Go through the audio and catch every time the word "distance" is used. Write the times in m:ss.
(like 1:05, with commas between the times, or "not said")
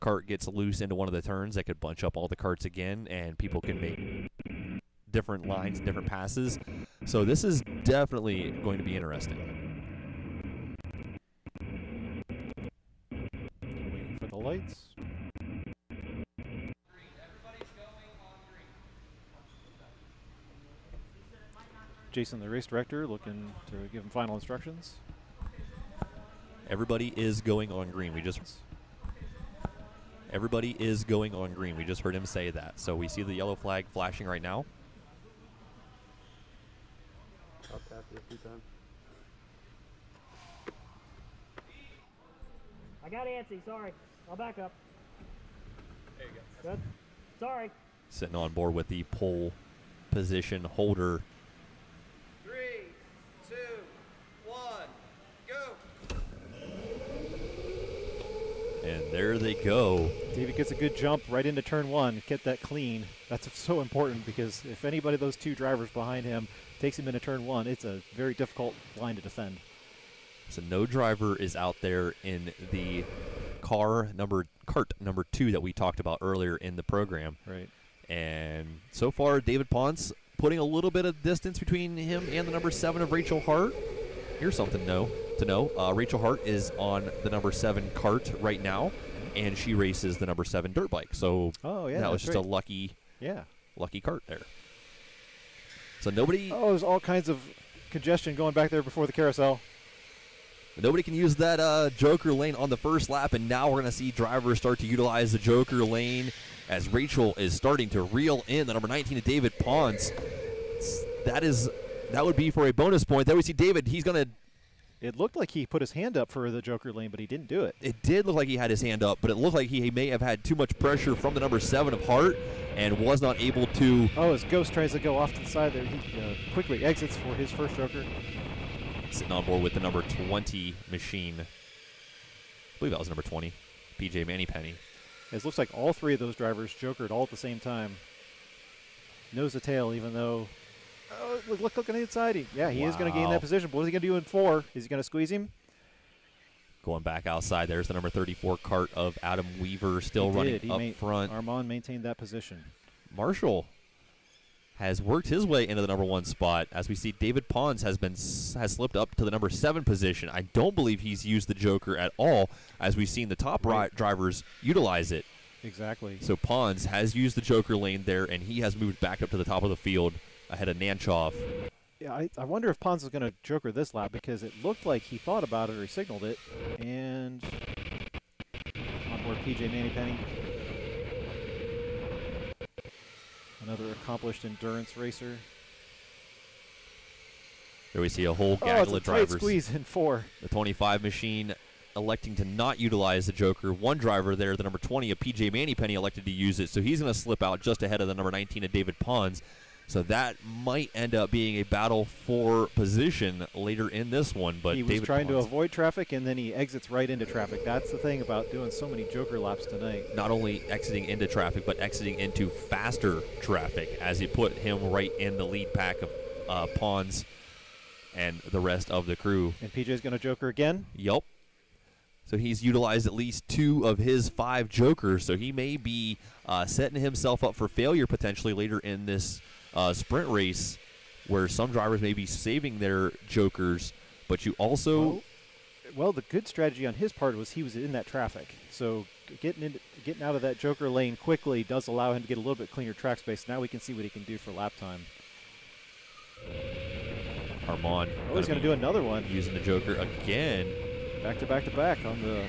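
1:21.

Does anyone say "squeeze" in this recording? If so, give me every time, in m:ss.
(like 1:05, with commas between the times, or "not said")
2:25, 3:09.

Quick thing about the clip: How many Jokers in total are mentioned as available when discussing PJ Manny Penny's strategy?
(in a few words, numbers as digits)
5.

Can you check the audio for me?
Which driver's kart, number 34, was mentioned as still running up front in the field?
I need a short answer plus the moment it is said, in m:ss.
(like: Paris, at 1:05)
Adam Weaver, at 2:29.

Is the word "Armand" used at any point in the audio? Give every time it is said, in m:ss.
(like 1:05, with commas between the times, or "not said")
2:31, 4:07.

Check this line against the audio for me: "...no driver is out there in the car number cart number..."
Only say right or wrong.
right.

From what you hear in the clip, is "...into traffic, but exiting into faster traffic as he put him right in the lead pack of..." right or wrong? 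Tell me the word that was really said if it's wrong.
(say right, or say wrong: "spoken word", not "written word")
right.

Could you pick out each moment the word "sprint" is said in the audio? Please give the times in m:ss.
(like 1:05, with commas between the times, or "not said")
3:49.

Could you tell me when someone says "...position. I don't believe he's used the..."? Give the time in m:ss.
2:39.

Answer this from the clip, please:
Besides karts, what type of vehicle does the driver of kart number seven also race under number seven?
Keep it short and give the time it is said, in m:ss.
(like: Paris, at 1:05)
Dirt bike, at 1:30.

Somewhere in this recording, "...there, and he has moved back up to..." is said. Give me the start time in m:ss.
2:48.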